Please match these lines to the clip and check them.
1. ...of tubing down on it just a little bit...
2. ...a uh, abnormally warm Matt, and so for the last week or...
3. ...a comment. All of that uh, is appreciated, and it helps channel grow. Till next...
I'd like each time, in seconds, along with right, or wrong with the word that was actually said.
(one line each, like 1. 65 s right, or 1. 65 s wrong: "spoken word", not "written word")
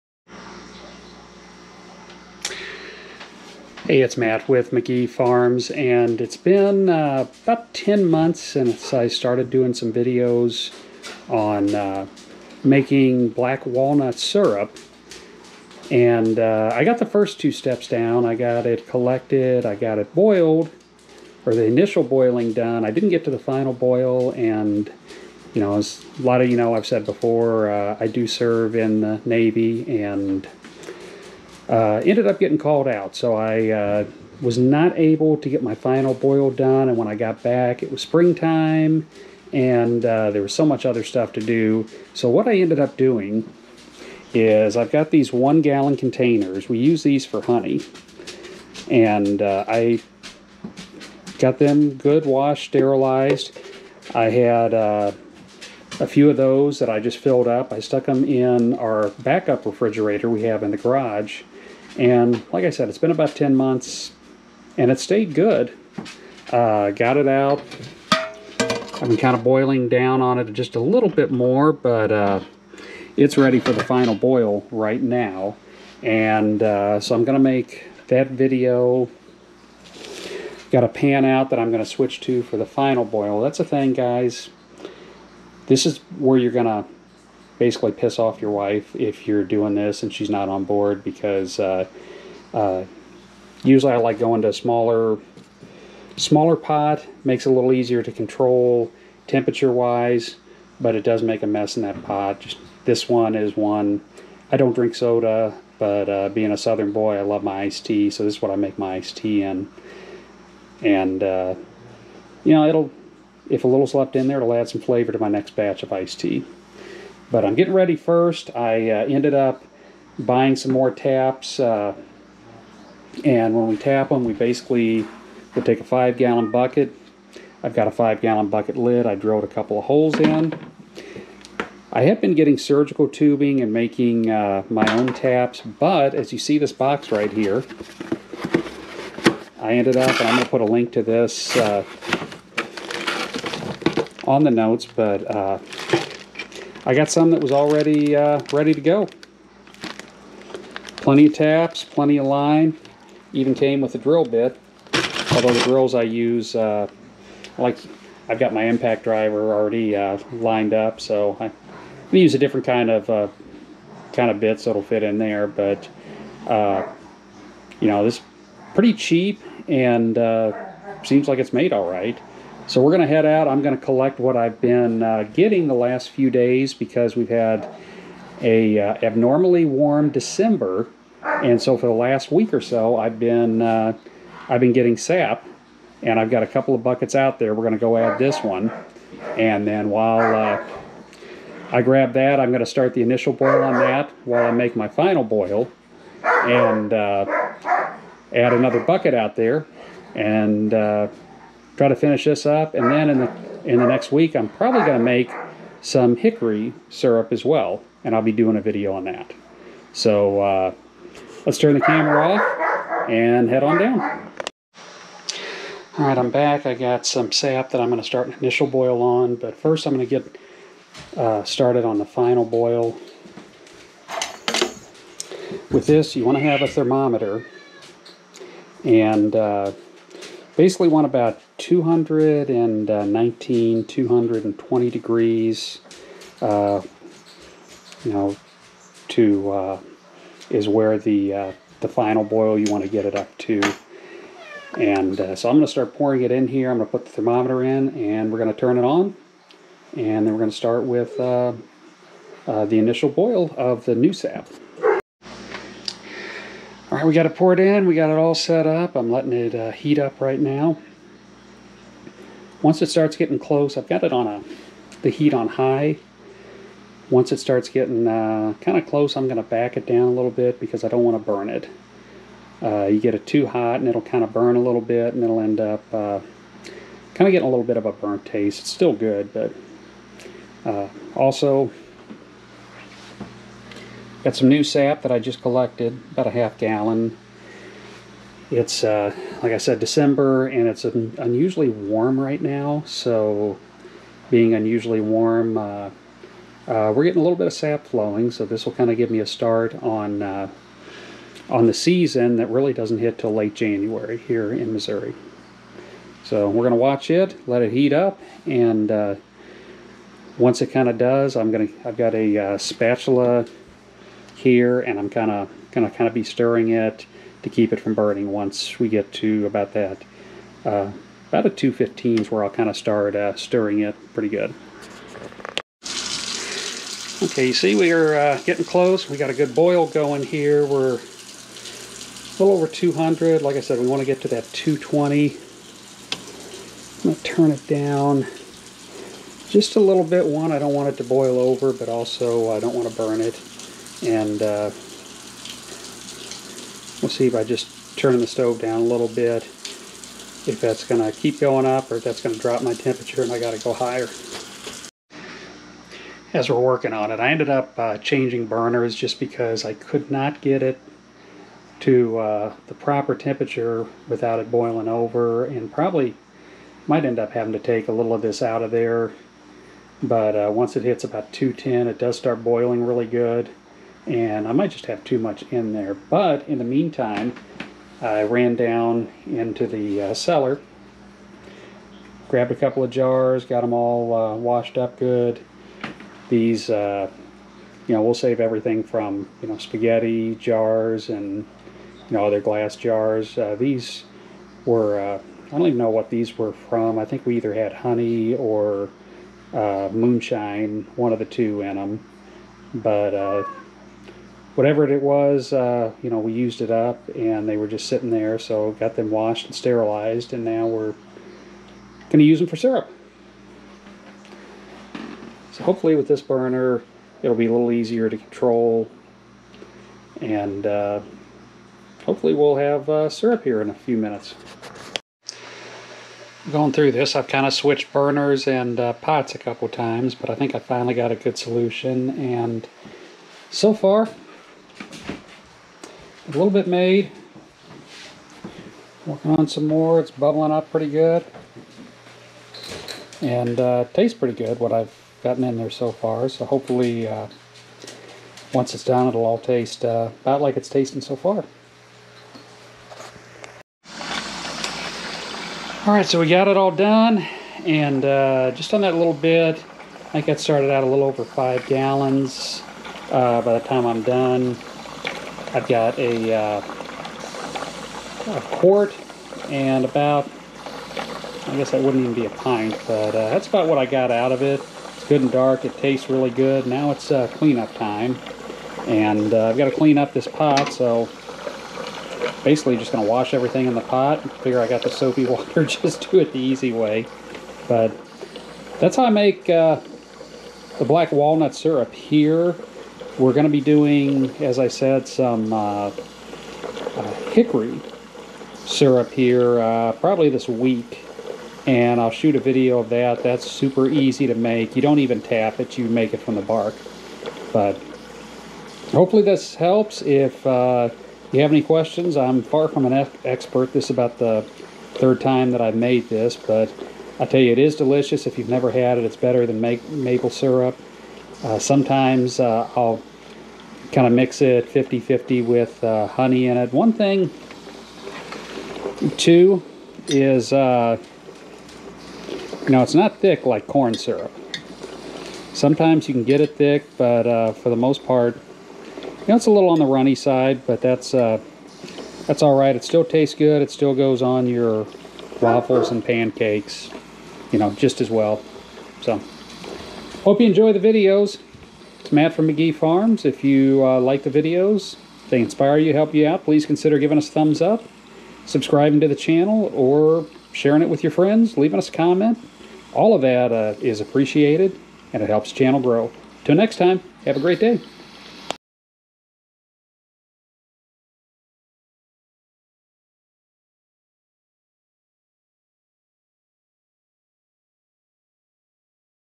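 1. 69 s wrong: "boiling", not "tubing"
2. 178 s wrong: "December", not "Matt"
3. 561 s right.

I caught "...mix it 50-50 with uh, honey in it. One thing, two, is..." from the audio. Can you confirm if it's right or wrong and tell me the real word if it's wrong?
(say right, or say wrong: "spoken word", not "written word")
right.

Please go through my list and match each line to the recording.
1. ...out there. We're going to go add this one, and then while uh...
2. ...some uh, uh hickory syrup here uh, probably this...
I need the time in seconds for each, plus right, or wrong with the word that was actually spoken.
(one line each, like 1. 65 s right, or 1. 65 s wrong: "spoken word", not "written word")
1. 187 s right
2. 495 s right.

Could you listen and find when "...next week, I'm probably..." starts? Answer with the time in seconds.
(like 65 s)
203 s.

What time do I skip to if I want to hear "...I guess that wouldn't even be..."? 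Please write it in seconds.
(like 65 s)
471 s.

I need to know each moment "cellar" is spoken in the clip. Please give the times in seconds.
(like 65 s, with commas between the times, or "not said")
380 s.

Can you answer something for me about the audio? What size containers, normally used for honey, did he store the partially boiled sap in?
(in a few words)
1 gallon.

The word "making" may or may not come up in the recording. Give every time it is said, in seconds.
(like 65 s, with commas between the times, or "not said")
12 s, 133 s.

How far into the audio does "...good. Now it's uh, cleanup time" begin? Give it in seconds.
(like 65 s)
476 s.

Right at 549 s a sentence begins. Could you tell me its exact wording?
So, hope you enjoy the videos it's Matt from Magee Farms.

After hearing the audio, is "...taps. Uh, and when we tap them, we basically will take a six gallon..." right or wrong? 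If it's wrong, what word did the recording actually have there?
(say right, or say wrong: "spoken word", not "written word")
wrong: "five", not "six".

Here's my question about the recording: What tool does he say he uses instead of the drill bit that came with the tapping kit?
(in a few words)
impact driver.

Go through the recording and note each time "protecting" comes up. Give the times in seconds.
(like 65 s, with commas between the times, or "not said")
not said.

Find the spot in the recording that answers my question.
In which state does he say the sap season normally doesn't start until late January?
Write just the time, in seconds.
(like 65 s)
304 s.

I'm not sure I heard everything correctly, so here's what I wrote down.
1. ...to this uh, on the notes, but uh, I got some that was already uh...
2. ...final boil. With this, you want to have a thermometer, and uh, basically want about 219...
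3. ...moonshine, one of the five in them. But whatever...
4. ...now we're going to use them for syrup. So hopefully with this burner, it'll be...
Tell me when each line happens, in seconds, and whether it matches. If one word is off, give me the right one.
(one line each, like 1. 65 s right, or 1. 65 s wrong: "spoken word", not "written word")
1. 140 s right
2. 222 s right
3. 399 s wrong: "two", not "five"
4. 410 s right.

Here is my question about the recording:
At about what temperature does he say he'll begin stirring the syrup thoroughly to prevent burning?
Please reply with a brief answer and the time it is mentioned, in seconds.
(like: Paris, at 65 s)
215, at 321 s.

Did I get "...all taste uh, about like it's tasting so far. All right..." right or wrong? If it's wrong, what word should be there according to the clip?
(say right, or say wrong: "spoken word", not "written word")
right.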